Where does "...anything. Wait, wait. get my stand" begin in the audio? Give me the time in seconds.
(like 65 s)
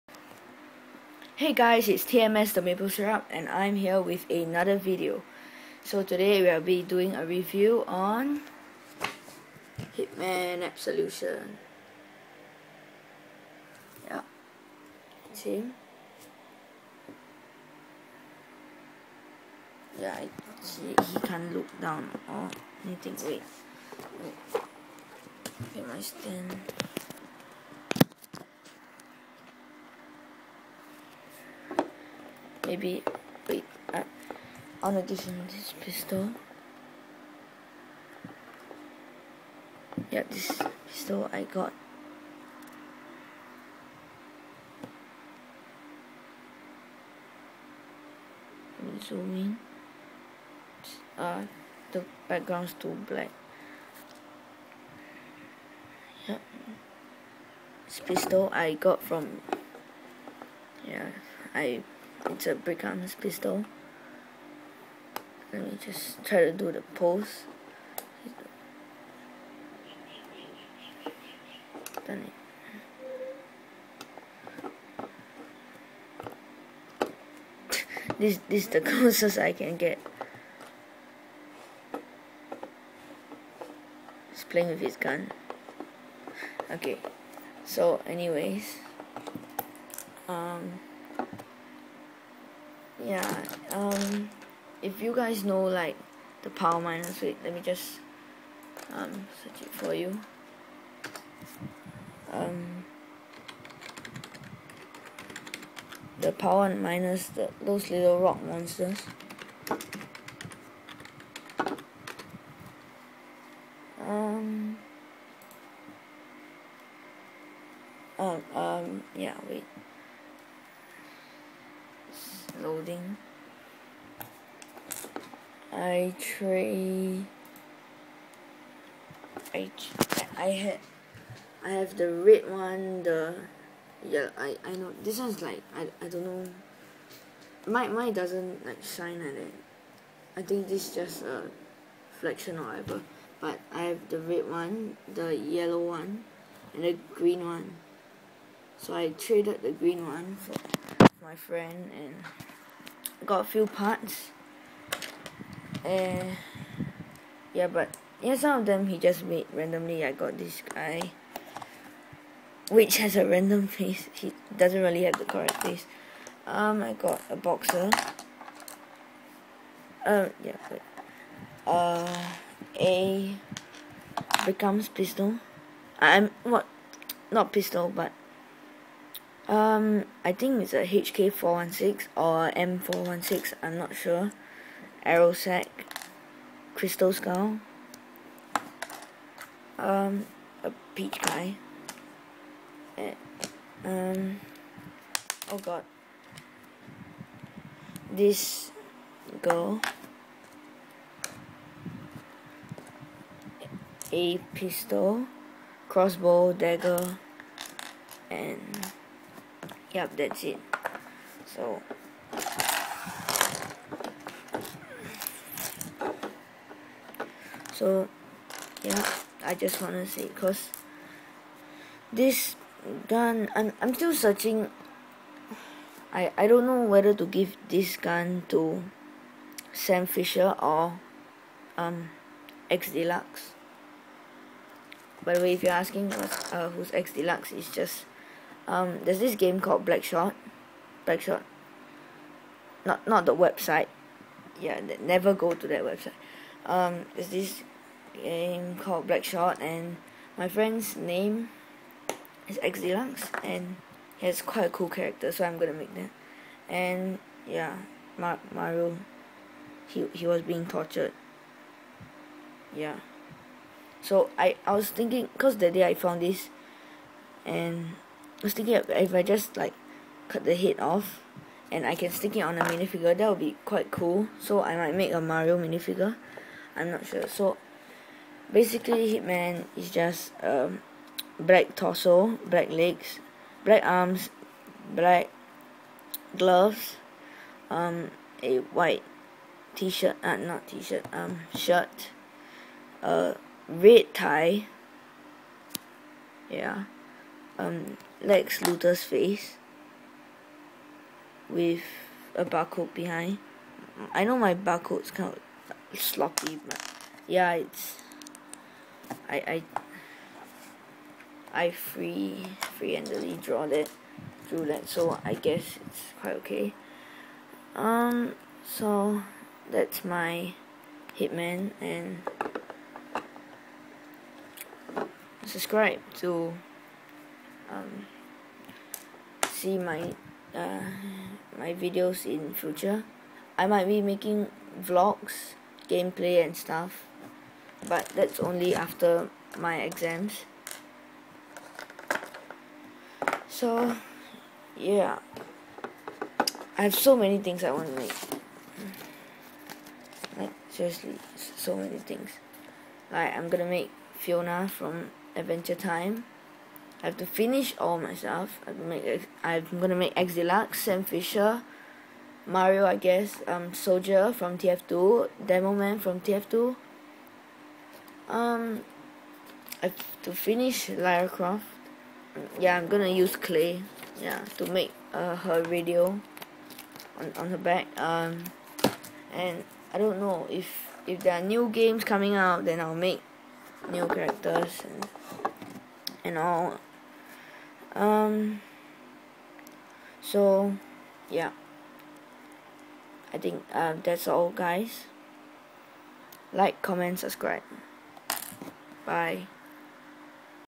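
22 s.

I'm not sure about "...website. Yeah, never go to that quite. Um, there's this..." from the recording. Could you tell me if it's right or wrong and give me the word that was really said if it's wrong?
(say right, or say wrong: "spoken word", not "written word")
wrong: "website", not "quite".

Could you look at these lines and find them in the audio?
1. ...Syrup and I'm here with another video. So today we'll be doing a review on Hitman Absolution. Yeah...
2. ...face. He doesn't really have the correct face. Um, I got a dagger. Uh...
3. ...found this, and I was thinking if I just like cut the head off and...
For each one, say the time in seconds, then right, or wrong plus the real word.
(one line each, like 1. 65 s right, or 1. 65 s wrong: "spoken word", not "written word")
1. 2 s right
2. 163 s wrong: "boxer", not "dagger"
3. 265 s right.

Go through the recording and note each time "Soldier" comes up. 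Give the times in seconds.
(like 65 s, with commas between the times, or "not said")
363 s.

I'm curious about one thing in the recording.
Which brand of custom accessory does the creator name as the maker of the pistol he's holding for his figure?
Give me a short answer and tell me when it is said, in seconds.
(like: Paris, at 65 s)
BrickArms, at 62 s.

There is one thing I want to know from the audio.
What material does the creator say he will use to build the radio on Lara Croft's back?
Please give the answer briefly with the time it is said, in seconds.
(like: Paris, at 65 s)
clay, at 373 s.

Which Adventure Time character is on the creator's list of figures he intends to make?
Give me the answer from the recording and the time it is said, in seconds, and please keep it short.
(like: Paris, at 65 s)
Fiona, at 354 s.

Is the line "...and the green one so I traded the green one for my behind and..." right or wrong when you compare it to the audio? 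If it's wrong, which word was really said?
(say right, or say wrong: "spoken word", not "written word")
wrong: "friend", not "behind".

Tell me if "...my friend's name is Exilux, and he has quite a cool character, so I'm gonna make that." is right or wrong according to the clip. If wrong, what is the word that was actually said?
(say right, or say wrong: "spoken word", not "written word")
right.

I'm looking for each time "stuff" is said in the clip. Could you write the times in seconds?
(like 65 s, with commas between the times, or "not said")
336 s, 358 s.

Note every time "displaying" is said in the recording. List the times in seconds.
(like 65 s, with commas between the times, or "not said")
not said.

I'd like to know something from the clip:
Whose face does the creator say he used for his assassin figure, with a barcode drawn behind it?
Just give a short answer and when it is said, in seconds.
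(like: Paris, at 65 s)
Lex Luthor, at 298 s.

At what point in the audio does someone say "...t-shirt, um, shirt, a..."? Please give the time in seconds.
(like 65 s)
290 s.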